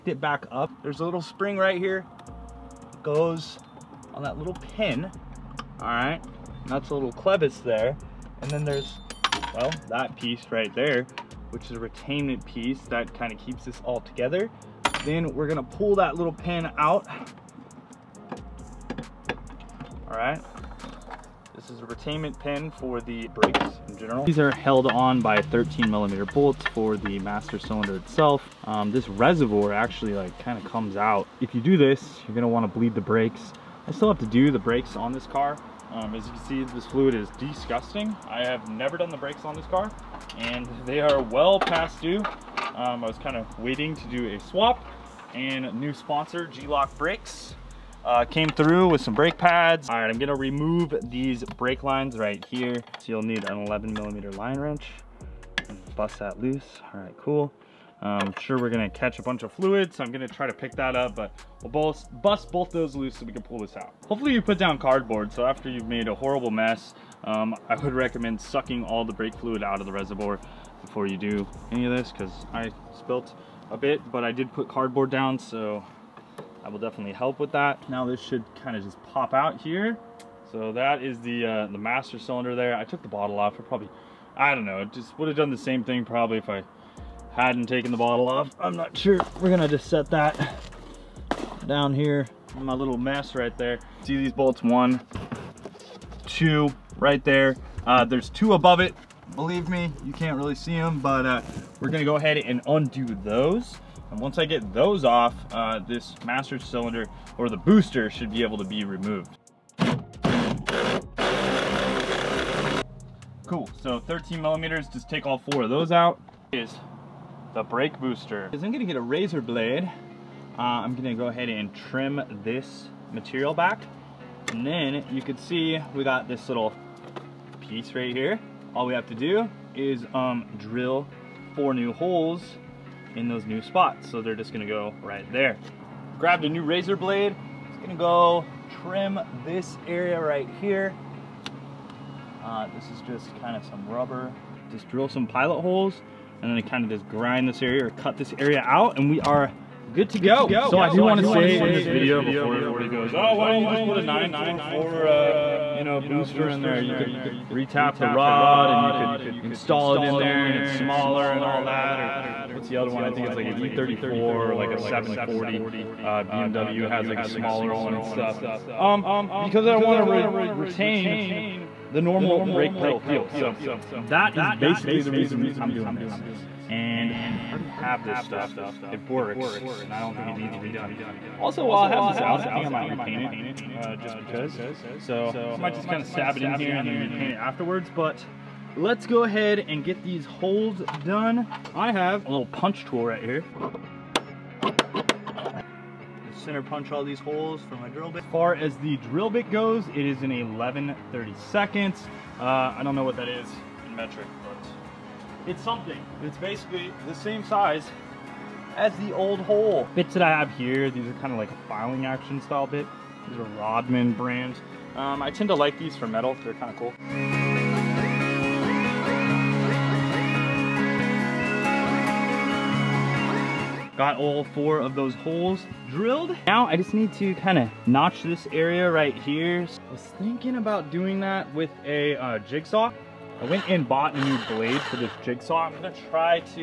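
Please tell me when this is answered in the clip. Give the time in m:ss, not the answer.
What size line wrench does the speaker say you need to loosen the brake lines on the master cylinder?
0:53.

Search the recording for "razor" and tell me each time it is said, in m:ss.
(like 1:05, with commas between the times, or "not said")
1:59, 2:16.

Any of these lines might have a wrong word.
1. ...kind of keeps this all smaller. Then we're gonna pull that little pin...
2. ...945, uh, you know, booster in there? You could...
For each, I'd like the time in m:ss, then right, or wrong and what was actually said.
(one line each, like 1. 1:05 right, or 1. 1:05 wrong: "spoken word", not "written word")
1. 0:13 wrong: "together", not "smaller"
2. 2:34 wrong: "944", not "945".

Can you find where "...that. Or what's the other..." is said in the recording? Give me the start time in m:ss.
2:41.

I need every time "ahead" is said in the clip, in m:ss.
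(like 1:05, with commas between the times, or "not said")
1:42, 2:01, 3:09.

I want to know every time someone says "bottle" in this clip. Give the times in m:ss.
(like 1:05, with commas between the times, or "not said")
1:23, 1:27.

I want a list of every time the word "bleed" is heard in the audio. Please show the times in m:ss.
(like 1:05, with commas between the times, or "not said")
0:32.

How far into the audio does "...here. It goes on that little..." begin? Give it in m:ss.
0:01.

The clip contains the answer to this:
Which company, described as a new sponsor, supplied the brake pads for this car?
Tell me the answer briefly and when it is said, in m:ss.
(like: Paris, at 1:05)
G-LOC Brakes, at 0:46.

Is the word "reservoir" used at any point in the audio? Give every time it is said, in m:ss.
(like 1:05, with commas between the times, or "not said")
0:29, 1:09.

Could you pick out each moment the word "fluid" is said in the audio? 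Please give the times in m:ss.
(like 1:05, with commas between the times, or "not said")
0:36, 0:59, 1:09.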